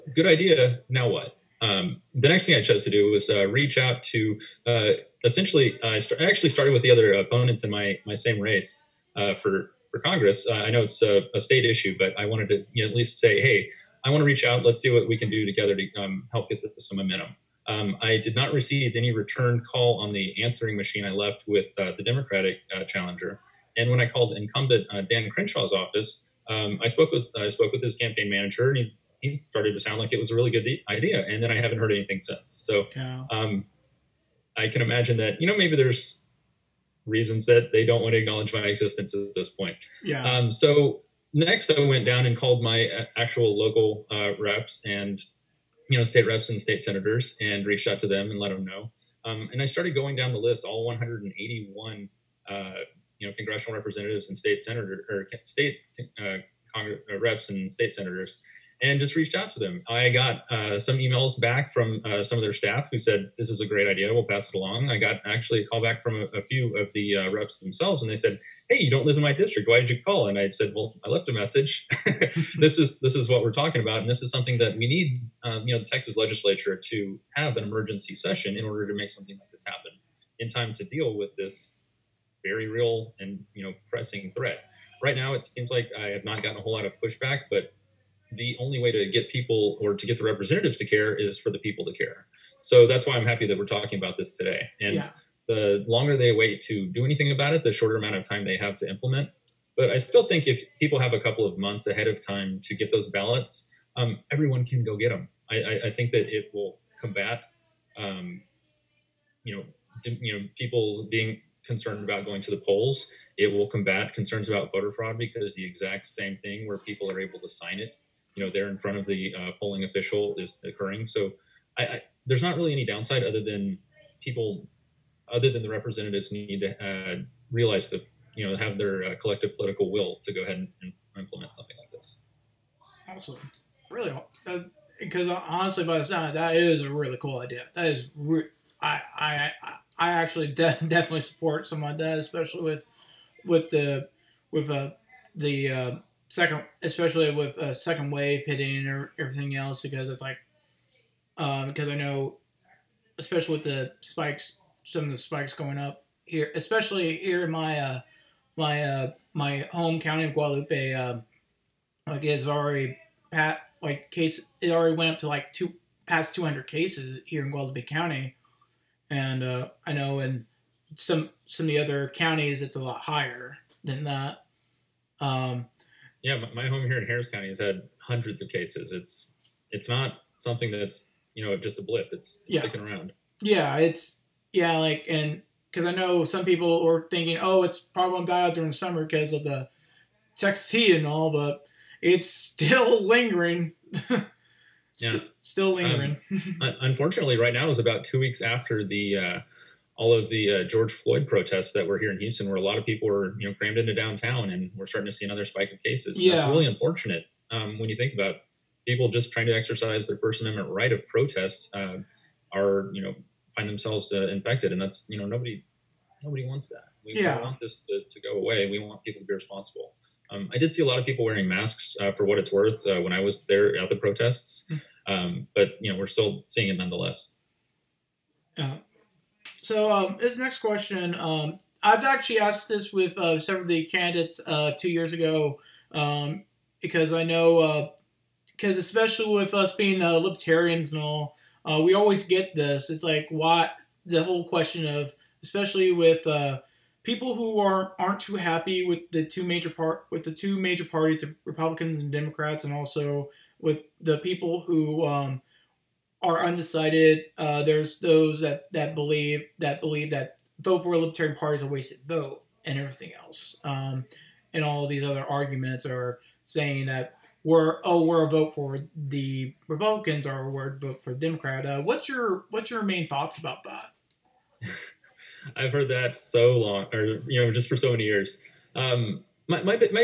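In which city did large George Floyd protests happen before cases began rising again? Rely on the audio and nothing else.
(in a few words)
Houston.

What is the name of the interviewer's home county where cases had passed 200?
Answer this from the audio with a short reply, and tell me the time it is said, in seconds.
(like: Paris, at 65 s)
Guadalupe County, at 167 s.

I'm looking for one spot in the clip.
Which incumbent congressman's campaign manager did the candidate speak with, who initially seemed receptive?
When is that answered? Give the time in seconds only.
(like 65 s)
25 s.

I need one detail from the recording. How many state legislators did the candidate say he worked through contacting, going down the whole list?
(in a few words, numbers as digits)
181.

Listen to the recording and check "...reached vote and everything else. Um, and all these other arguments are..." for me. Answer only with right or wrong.
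wrong.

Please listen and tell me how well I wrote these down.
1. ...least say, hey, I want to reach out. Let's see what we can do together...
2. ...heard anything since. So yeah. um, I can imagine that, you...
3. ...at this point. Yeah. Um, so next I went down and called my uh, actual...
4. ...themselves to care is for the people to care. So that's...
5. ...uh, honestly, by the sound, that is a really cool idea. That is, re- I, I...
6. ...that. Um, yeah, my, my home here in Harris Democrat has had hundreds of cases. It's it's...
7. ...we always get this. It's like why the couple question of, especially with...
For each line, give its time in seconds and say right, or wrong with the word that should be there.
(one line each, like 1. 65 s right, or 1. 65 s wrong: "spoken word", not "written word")
1. 12 s right
2. 31 s right
3. 39 s right
4. 90 s wrong: "representatives", not "themselves"
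5. 135 s right
6. 174 s wrong: "County", not "Democrat"
7. 241 s wrong: "whole", not "couple".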